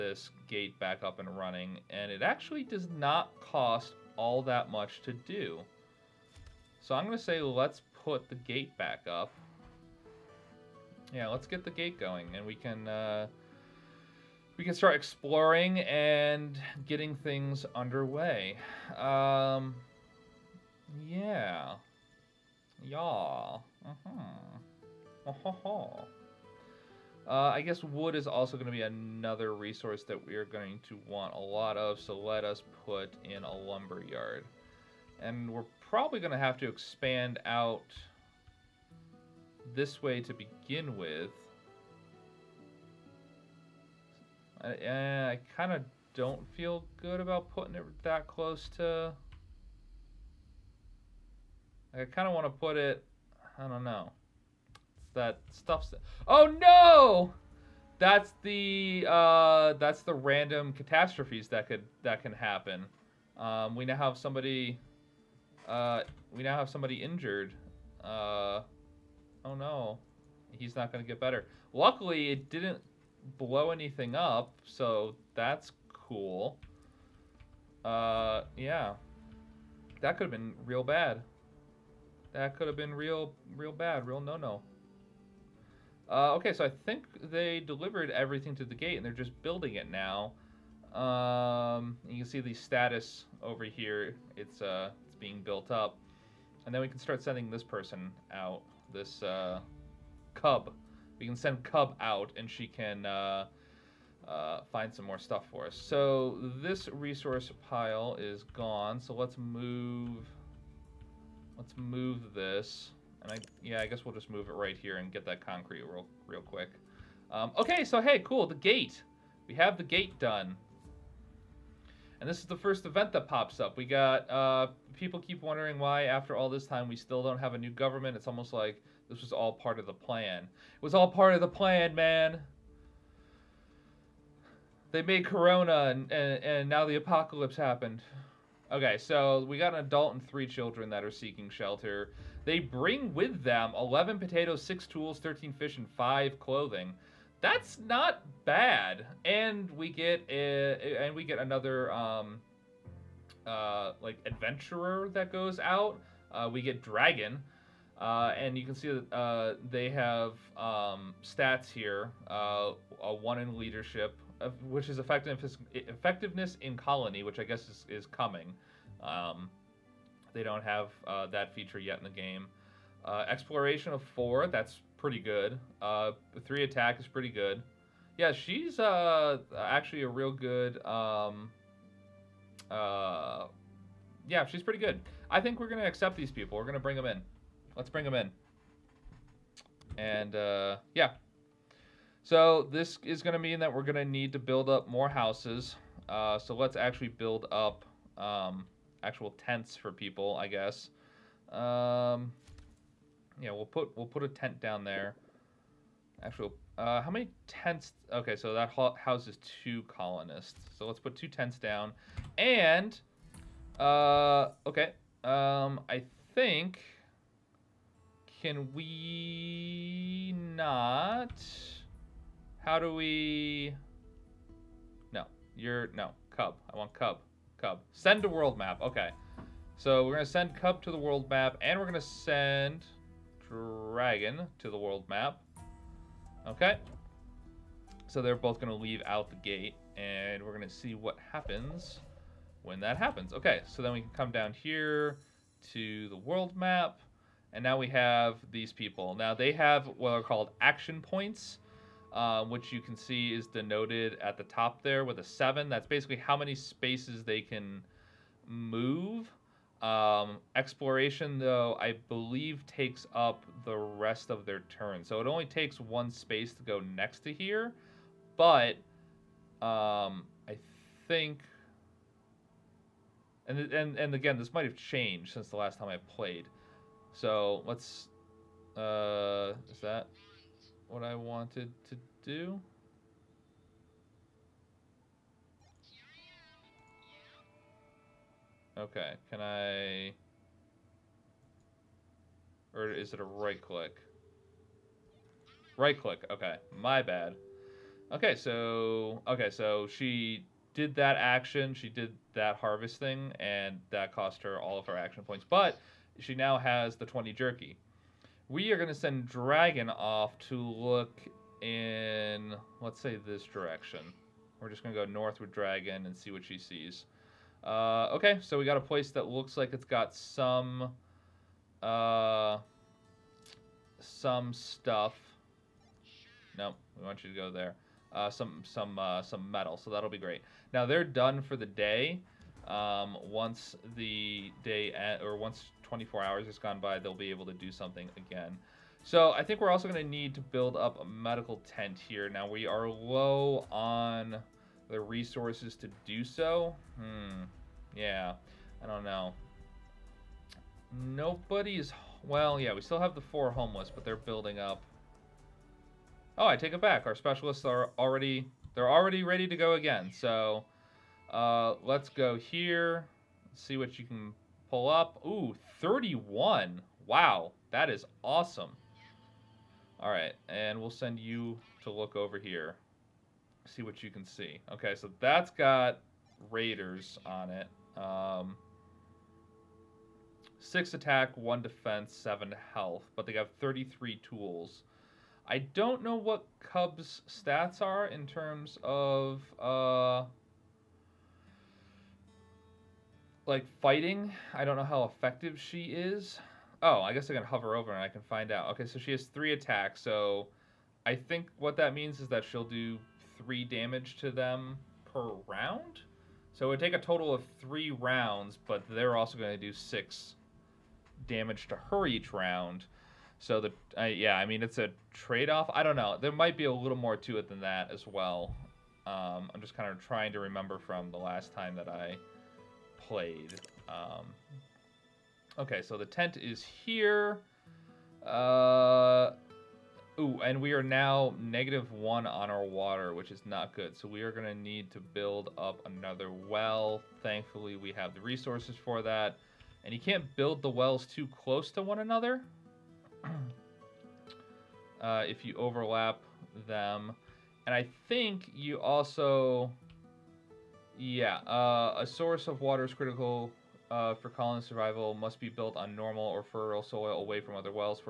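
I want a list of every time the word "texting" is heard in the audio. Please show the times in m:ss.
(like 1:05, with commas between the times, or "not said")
not said.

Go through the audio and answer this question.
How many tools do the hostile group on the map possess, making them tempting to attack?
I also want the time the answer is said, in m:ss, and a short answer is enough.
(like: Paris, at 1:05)
33, at 6:23.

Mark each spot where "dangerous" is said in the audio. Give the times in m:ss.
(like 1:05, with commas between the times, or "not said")
not said.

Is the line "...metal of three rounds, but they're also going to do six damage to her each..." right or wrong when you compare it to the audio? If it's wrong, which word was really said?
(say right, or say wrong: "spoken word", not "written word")
wrong: "total", not "metal".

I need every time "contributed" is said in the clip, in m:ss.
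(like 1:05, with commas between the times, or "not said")
not said.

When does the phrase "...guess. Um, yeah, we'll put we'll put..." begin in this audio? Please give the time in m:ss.
3:20.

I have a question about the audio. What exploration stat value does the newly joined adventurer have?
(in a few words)
4.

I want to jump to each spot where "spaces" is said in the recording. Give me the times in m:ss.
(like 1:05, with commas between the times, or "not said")
4:16, 4:26.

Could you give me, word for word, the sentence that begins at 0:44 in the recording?
I, eh, I kind of don't feel good about putting it that close to...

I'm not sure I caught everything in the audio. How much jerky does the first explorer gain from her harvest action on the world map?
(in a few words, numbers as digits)
20.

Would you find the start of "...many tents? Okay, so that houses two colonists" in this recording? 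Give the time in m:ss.
3:27.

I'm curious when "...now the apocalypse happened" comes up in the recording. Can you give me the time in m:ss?
2:16.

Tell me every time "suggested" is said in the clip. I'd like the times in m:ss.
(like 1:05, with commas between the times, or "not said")
not said.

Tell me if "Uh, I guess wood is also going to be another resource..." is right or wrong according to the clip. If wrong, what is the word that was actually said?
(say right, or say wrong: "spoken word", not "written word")
right.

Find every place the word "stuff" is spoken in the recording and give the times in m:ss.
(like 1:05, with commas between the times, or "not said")
0:55, 1:45, 5:24.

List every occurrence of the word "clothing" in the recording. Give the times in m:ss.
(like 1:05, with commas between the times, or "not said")
2:26.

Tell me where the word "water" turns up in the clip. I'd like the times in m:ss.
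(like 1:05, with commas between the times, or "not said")
7:12, 7:32.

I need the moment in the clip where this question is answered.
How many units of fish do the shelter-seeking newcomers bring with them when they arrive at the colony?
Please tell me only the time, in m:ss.
2:25.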